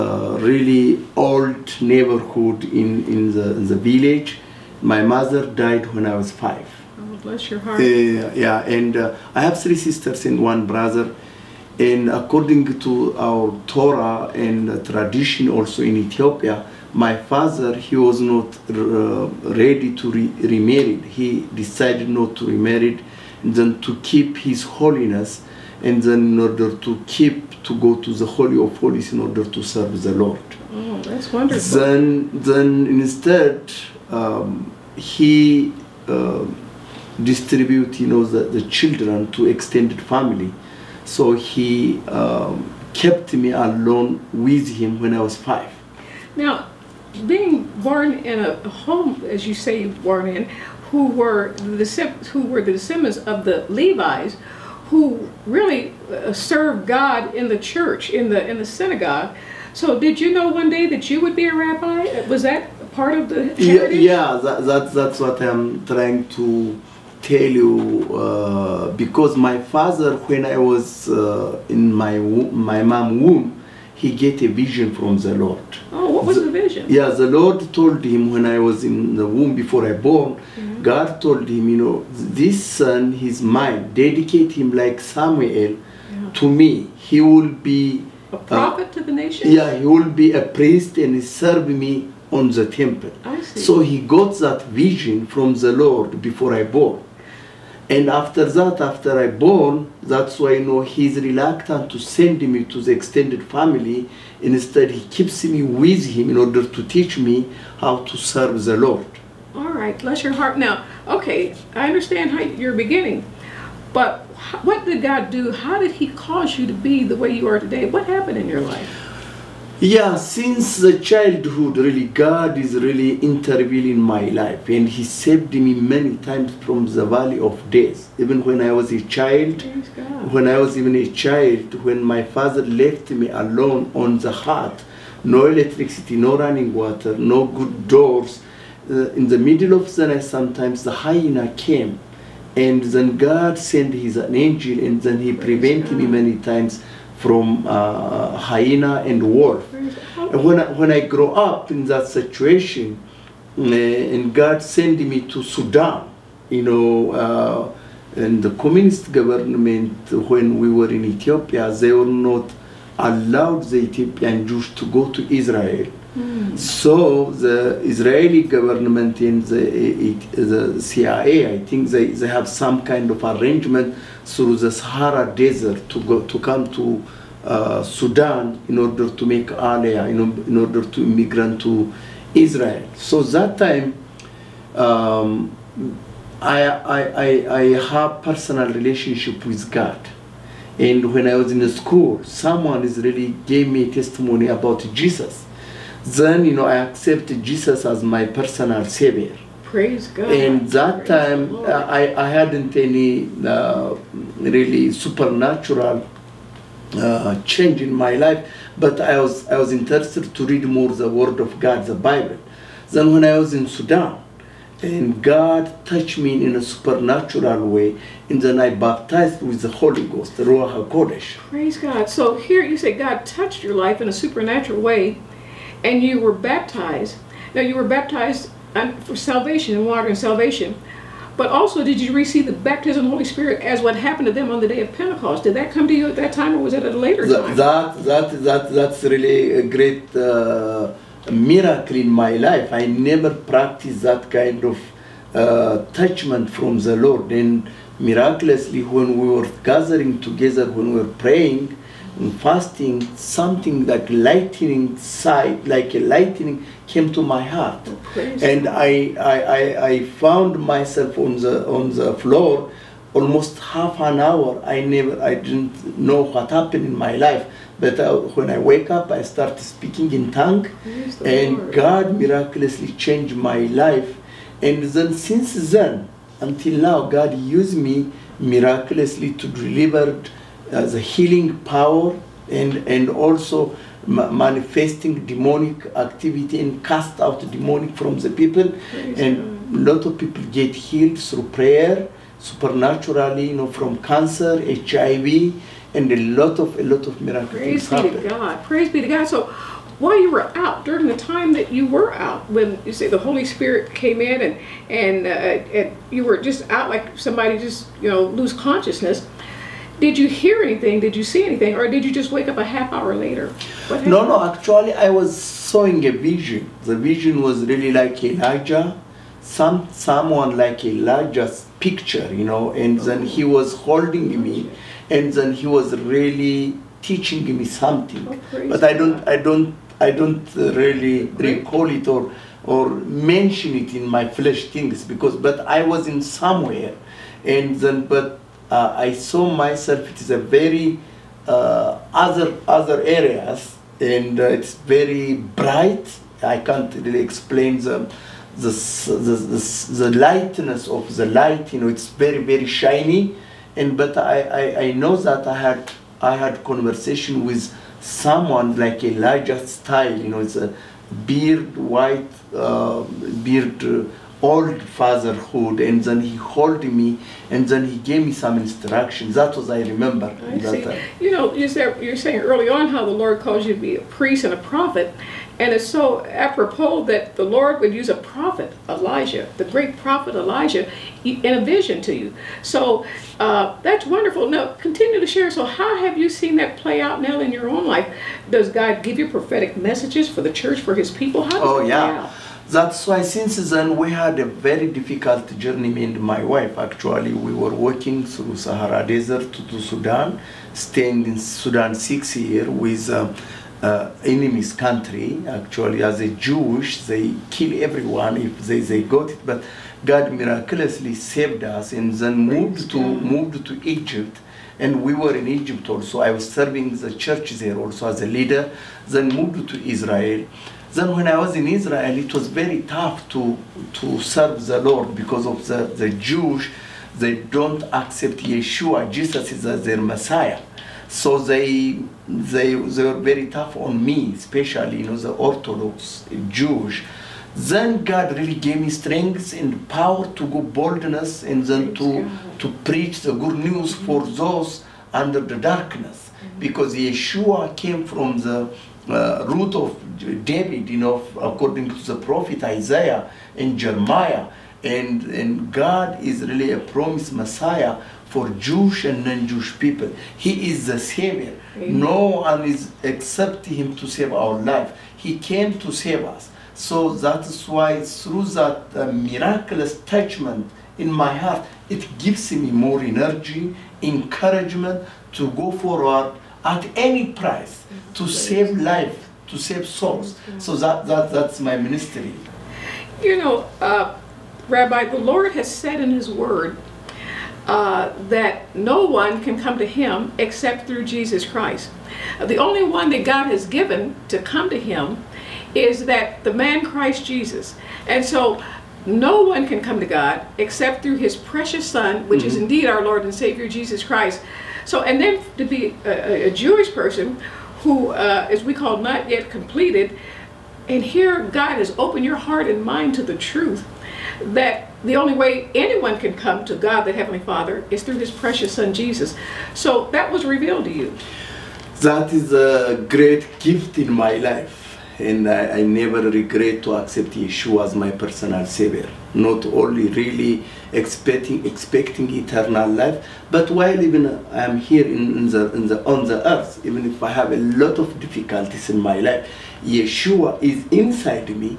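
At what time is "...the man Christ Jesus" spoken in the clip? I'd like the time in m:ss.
8:16.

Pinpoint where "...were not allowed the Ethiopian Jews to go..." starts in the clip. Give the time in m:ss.
2:41.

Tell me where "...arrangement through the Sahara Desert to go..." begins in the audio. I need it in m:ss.
2:53.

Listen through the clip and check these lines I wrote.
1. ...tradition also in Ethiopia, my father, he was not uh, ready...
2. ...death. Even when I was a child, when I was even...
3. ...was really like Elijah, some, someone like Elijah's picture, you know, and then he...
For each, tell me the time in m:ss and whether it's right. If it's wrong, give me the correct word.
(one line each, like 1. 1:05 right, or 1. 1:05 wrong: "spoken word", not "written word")
1. 0:14 right
2. 2:07 right
3. 5:17 right.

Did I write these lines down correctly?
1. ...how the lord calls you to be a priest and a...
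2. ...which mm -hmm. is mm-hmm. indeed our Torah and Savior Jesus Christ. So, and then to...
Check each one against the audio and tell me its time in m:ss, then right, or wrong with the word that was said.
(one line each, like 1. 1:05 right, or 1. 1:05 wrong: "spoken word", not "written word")
1. 6:12 right
2. 8:22 wrong: "Lord", not "Torah".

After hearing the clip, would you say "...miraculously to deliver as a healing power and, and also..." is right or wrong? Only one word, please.
right.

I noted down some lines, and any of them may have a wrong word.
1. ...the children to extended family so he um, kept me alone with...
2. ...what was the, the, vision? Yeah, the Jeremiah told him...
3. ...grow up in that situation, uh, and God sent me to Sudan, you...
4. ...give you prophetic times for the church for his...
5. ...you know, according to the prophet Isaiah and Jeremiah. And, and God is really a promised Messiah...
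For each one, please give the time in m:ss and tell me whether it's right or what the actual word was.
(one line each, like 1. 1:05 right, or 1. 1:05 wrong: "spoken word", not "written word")
1. 0:38 right
2. 1:16 wrong: "Lord", not "Jeremiah"
3. 2:31 right
4. 6:29 wrong: "messages", not "times"
5. 7:30 right.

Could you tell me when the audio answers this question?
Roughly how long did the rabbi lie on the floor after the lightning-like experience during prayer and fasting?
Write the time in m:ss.
4:23.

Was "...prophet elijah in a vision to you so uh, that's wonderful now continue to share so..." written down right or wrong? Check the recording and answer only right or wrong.
right.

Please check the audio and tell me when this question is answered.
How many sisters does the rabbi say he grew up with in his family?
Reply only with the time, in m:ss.
0:09.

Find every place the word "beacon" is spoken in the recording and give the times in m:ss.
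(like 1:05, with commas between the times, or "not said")
not said.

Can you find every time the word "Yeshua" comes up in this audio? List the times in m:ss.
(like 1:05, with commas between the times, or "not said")
7:08, 7:26, 8:47, 8:59.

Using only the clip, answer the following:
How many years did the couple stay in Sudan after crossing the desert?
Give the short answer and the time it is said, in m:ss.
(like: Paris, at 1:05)
6, at 6:41.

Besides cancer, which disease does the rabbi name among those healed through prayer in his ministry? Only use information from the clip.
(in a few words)
HIV.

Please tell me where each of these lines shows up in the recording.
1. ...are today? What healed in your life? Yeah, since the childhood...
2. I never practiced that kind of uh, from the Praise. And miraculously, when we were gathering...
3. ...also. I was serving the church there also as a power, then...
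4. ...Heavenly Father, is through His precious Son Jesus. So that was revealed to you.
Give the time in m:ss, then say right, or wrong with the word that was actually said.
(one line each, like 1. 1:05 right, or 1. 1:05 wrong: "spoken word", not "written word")
1. 1:57 wrong: "happened", not "healed"
2. 4:02 wrong: "Lord", not "Praise"
3. 6:55 wrong: "leader", not "power"
4. 8:37 right.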